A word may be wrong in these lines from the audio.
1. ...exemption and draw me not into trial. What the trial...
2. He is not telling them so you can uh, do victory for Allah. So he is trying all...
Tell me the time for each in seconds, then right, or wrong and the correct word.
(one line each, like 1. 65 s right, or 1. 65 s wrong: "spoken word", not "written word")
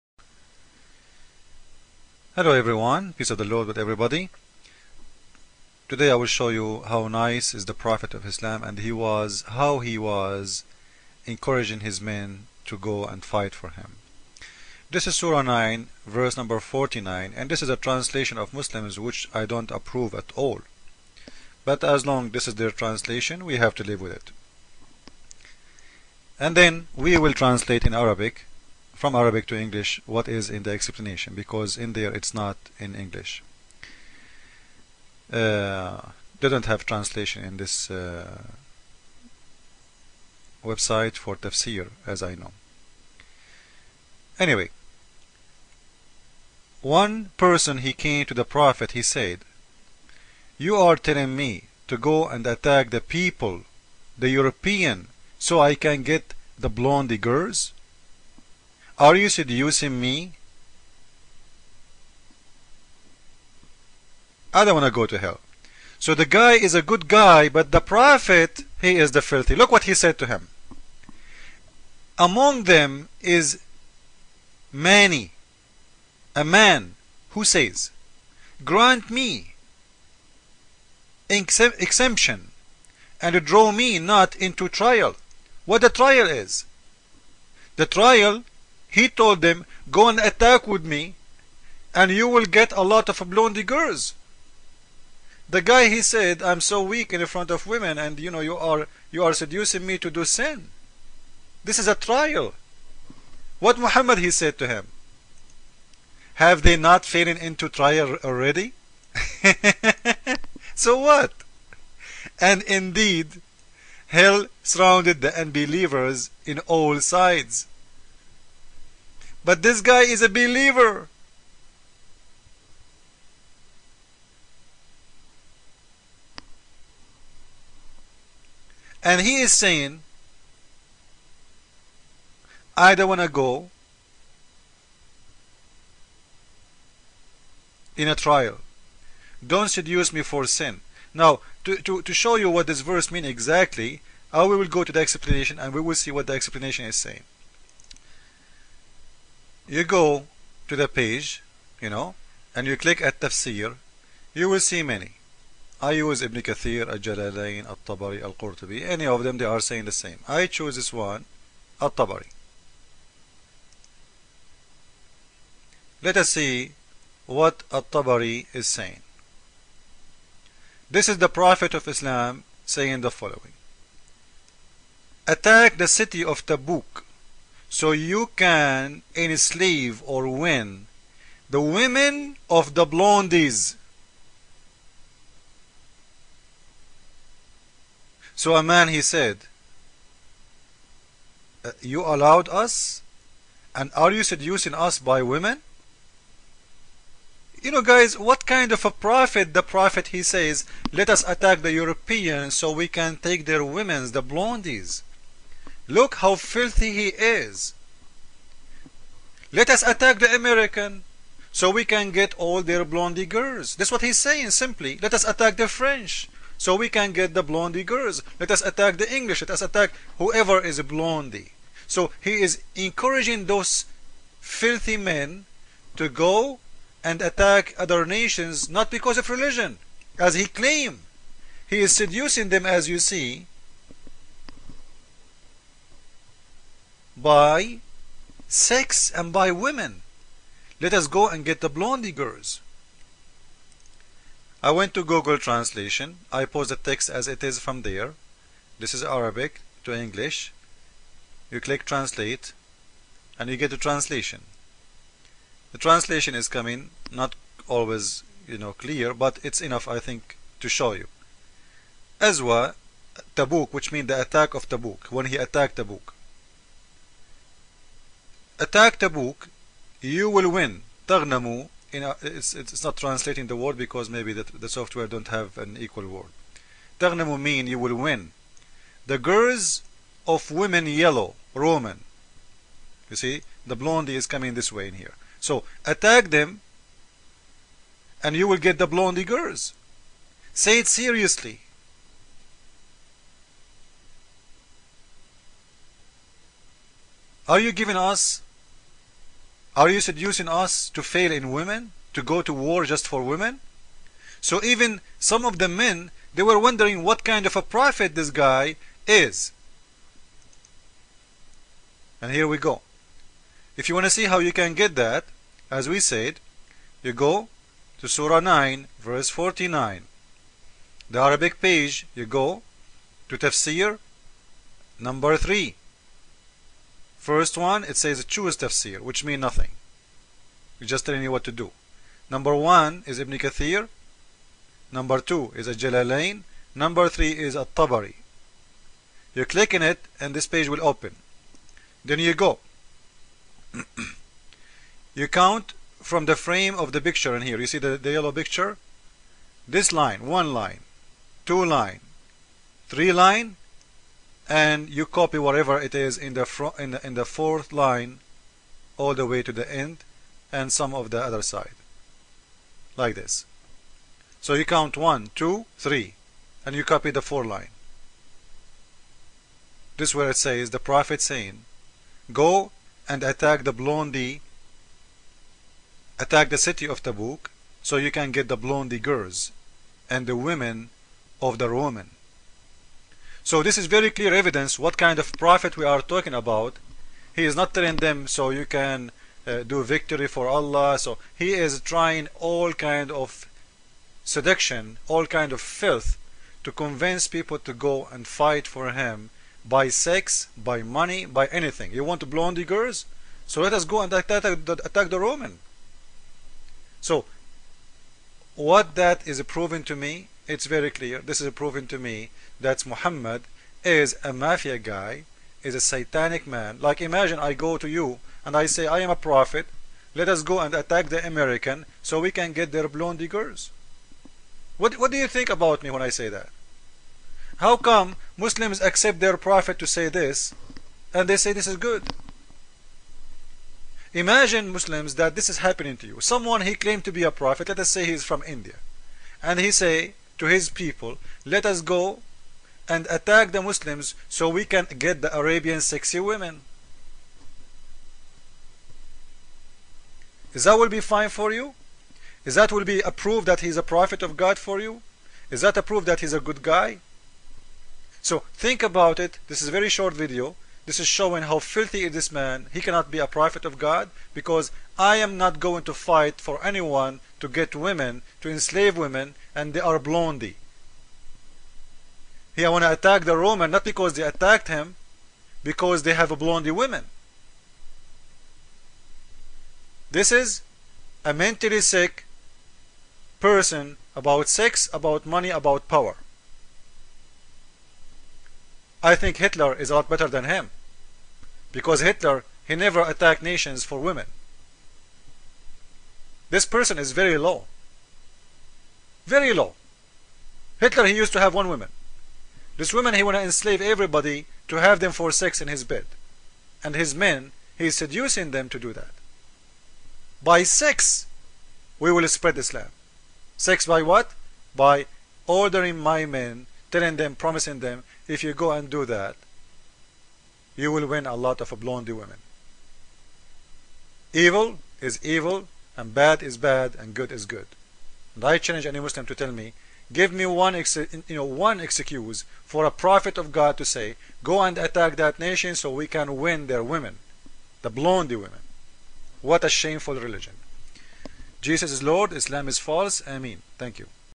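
1. 81 s right
2. 387 s right.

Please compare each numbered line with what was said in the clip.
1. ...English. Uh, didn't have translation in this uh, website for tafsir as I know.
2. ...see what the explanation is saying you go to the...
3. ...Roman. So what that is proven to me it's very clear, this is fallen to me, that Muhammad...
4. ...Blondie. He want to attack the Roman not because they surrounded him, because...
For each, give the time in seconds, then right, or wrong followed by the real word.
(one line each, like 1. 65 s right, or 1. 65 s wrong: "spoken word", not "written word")
1. 32 s right
2. 145 s right
3. 405 s wrong: "proven", not "fallen"
4. 469 s wrong: "attacked", not "surrounded".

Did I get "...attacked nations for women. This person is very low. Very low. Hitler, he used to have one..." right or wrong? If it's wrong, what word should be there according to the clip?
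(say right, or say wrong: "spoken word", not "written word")
right.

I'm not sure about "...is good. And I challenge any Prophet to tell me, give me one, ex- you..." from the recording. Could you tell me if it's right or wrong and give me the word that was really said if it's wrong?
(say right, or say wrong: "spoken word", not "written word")
wrong: "Muslim", not "Prophet".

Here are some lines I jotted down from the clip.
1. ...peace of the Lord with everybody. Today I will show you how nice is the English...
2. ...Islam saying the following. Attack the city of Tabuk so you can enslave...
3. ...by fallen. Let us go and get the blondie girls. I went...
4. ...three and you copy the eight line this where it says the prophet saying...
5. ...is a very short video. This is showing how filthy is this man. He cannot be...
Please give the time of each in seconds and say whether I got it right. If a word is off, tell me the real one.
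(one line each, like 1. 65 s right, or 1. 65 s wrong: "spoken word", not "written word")
1. 3 s wrong: "Prophet", not "English"
2. 171 s right
3. 239 s wrong: "women", not "fallen"
4. 365 s wrong: "four", not "eight"
5. 459 s right.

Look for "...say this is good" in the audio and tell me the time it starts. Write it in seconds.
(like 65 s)
431 s.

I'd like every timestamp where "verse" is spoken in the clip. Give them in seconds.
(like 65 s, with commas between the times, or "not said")
16 s, 142 s, 318 s.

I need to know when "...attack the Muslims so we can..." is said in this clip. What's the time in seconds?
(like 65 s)
443 s.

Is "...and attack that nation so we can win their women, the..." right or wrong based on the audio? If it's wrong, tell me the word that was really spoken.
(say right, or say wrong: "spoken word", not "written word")
right.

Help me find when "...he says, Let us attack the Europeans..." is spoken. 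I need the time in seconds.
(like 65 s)
200 s.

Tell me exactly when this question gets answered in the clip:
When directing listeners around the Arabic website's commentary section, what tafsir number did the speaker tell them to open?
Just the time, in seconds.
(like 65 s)
323 s.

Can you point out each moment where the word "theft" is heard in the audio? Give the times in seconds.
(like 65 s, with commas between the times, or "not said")
not said.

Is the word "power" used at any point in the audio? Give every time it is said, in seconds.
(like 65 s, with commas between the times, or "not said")
485 s.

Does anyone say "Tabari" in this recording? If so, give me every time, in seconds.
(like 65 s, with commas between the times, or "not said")
157 s, 161 s, 167 s, 337 s.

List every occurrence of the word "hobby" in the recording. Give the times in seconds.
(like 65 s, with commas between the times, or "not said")
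not said.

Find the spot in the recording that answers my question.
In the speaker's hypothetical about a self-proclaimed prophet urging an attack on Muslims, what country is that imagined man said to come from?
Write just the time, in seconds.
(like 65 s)
438 s.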